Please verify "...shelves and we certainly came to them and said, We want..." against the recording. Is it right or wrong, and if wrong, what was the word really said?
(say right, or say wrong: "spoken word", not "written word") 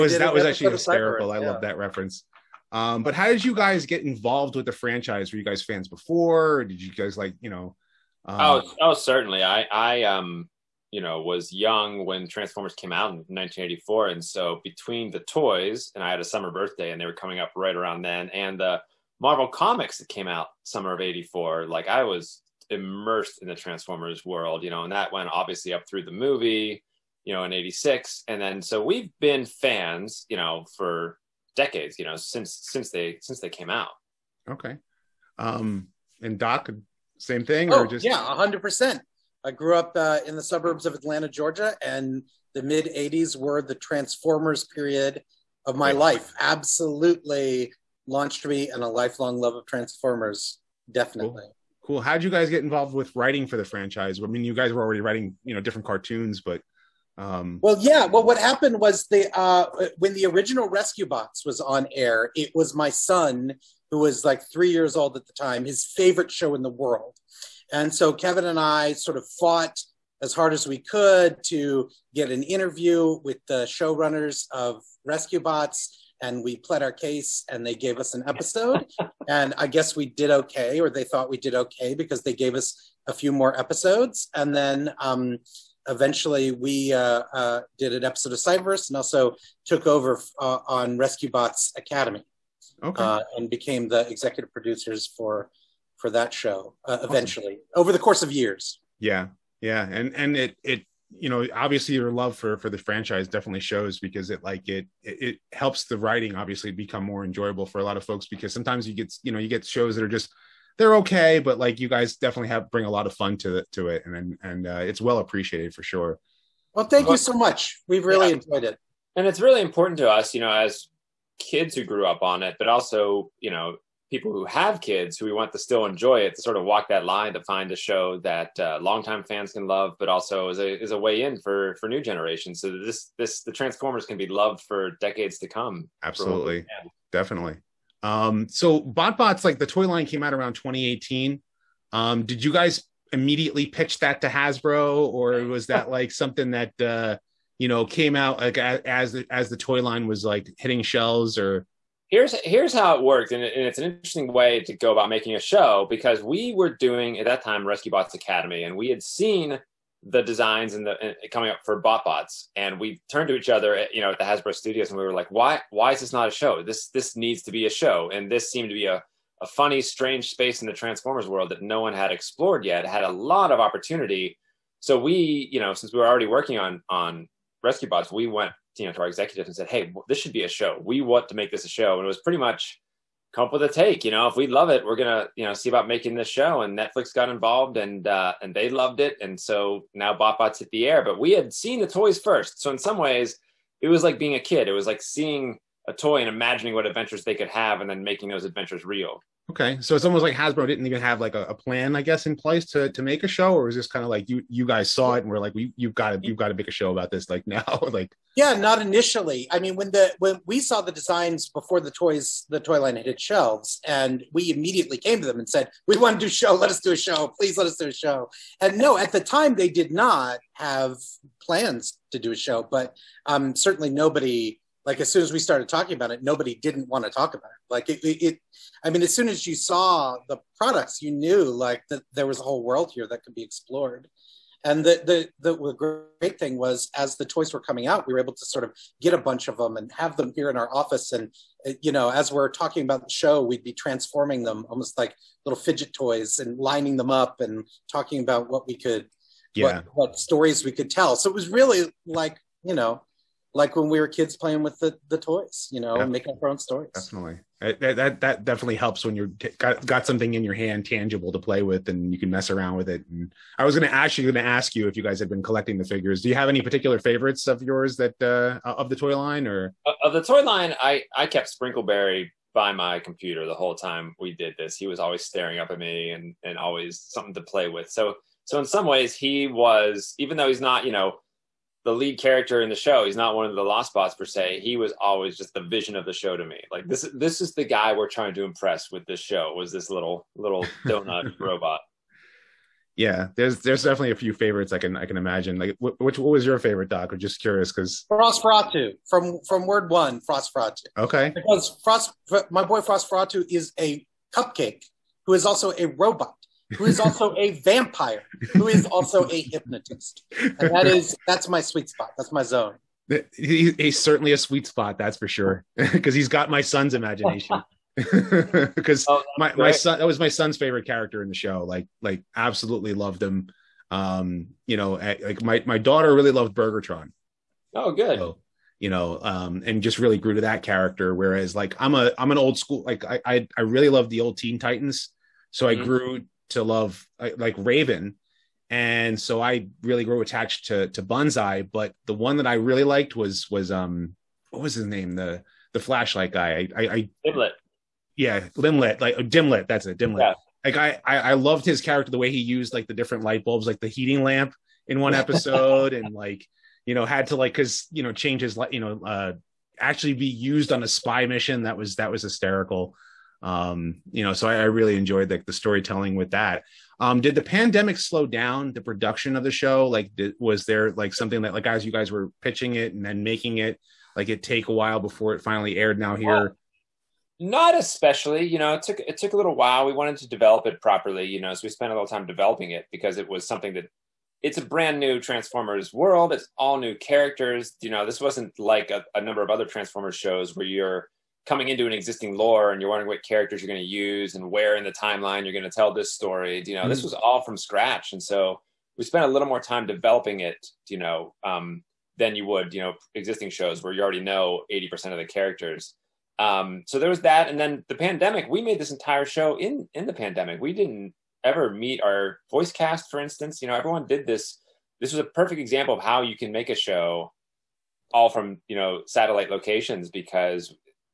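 wrong: "immediately", not "certainly".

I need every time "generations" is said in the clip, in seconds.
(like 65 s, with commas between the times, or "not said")
132 s.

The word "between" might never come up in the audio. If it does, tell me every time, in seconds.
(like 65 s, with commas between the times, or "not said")
14 s.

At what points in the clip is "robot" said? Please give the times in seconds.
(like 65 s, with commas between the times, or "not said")
291 s, 305 s.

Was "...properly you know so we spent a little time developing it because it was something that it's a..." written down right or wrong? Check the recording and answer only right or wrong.
right.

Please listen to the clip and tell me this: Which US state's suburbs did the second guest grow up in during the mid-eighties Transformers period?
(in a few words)
Georgia.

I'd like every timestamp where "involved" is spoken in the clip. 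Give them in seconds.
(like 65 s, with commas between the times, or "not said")
4 s, 52 s, 187 s.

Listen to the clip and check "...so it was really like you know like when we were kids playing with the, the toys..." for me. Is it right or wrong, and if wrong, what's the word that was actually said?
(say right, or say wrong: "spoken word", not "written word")
right.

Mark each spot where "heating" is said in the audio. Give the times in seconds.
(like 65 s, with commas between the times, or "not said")
353 s.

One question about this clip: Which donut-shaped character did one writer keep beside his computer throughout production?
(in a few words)
Sprinkleberry.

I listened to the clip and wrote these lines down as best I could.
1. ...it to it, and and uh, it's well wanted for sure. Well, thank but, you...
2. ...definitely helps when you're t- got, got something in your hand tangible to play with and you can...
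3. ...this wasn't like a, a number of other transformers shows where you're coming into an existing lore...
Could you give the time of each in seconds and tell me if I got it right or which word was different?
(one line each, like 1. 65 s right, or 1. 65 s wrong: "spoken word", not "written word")
1. 113 s wrong: "appreciated", not "wanted"
2. 258 s right
3. 388 s right.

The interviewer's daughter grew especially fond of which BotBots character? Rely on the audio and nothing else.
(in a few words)
Burgertron.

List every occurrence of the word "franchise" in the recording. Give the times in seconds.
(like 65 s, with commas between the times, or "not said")
4 s, 53 s, 102 s.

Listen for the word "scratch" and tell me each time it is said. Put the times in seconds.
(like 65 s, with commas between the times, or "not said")
397 s.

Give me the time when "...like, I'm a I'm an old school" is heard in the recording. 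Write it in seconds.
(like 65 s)
331 s.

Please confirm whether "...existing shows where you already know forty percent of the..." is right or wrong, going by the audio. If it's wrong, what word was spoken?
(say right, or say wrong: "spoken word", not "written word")
wrong: "eighty", not "forty".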